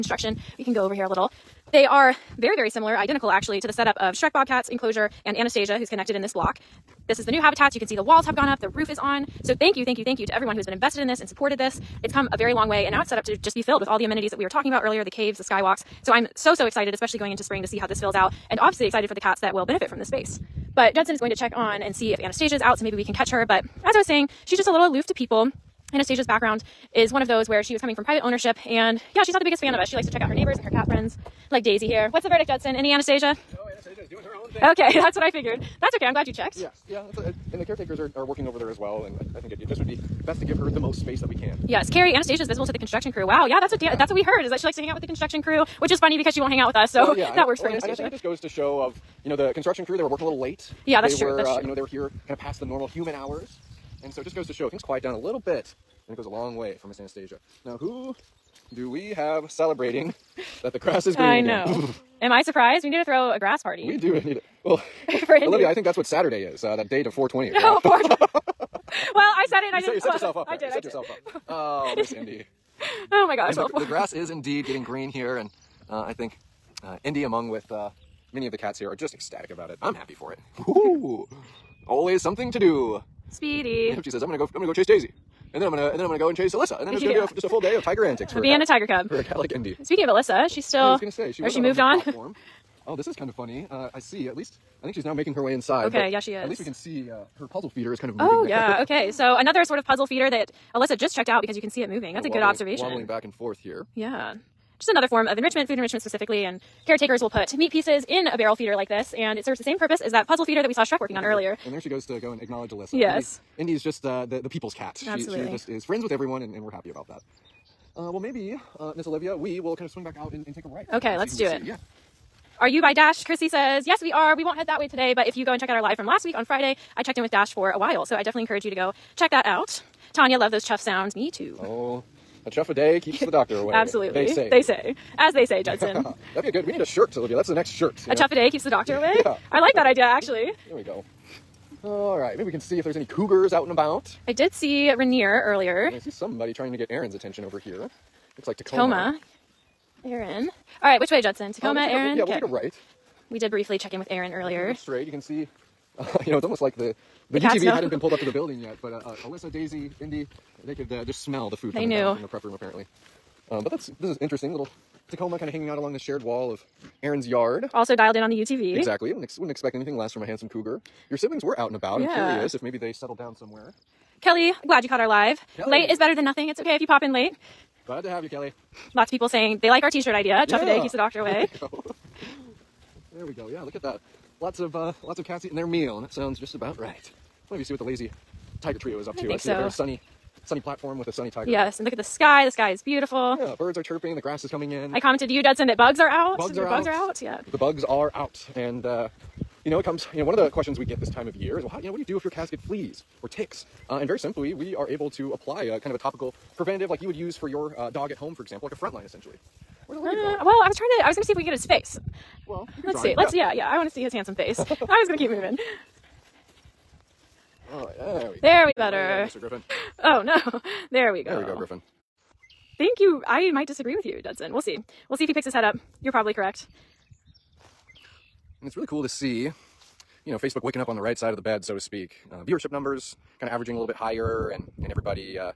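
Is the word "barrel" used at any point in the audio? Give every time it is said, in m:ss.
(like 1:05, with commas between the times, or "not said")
1:48.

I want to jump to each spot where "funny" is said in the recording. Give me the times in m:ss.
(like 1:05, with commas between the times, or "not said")
0:45, 1:33.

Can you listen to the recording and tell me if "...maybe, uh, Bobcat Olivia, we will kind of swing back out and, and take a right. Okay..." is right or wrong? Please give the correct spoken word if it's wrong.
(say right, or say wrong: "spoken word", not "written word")
wrong: "Miss", not "Bobcat".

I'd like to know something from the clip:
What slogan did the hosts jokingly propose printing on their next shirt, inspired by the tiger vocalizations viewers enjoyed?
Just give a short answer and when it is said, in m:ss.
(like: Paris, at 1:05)
A chuff a day keeps the doctor away, at 2:12.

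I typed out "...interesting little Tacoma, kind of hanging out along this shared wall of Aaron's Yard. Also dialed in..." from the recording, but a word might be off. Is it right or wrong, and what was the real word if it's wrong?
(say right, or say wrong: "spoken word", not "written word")
right.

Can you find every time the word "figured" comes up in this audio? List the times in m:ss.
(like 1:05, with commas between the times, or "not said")
0:35.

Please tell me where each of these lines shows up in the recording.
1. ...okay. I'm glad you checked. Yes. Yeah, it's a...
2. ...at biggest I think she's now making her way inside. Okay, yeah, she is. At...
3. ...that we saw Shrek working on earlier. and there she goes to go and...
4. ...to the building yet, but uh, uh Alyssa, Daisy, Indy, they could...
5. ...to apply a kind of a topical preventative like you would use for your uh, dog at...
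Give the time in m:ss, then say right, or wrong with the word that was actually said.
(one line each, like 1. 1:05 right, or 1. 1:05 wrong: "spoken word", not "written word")
1. 0:35 right
2. 1:34 wrong: "least", not "biggest"
3. 1:50 right
4. 2:38 right
5. 3:25 right.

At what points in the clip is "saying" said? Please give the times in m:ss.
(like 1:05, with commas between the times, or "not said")
0:24, 2:59.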